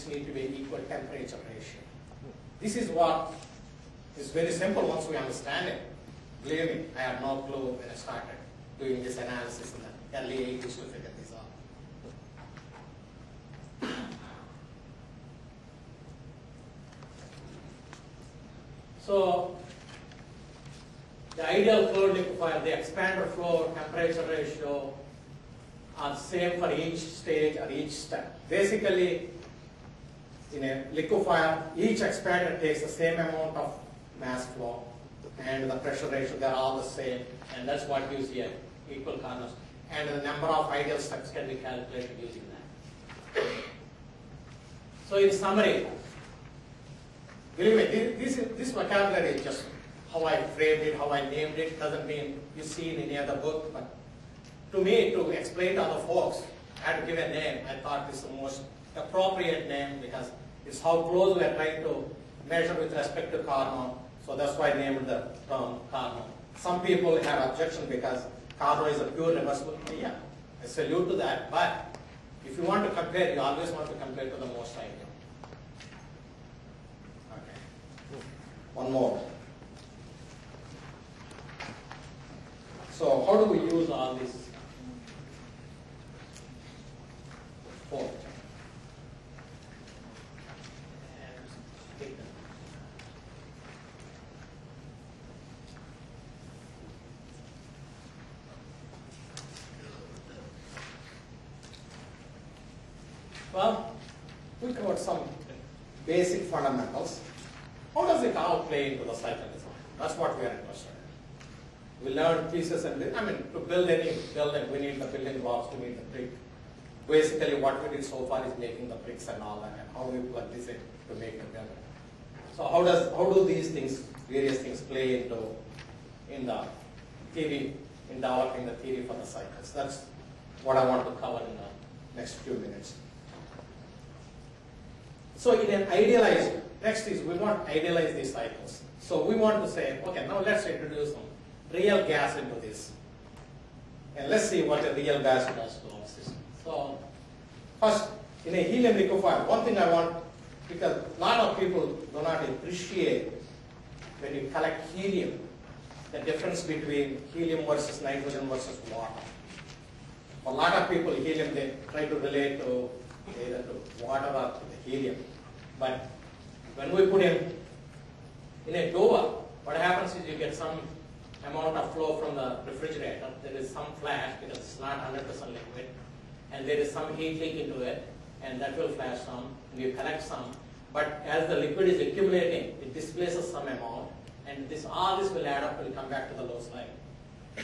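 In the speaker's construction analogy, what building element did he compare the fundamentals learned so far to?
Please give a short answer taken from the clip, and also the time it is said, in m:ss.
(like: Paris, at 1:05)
Bricks, at 1:59.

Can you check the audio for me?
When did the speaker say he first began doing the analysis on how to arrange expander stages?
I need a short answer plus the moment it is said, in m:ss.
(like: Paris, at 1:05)
Early 80s, at 0:10.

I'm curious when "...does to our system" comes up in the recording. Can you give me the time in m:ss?
2:25.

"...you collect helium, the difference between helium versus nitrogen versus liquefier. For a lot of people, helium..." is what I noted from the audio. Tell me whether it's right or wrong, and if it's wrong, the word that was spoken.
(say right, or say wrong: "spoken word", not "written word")
wrong: "water", not "liquefier".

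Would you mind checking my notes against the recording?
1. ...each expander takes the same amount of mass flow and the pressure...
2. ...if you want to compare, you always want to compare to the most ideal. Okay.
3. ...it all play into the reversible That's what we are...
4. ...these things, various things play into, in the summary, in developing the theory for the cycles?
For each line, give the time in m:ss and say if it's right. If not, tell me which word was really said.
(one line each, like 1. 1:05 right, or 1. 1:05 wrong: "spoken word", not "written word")
1. 0:31 right
2. 1:12 right
3. 1:48 wrong: "cycle", not "reversible"
4. 2:03 wrong: "theory", not "summary".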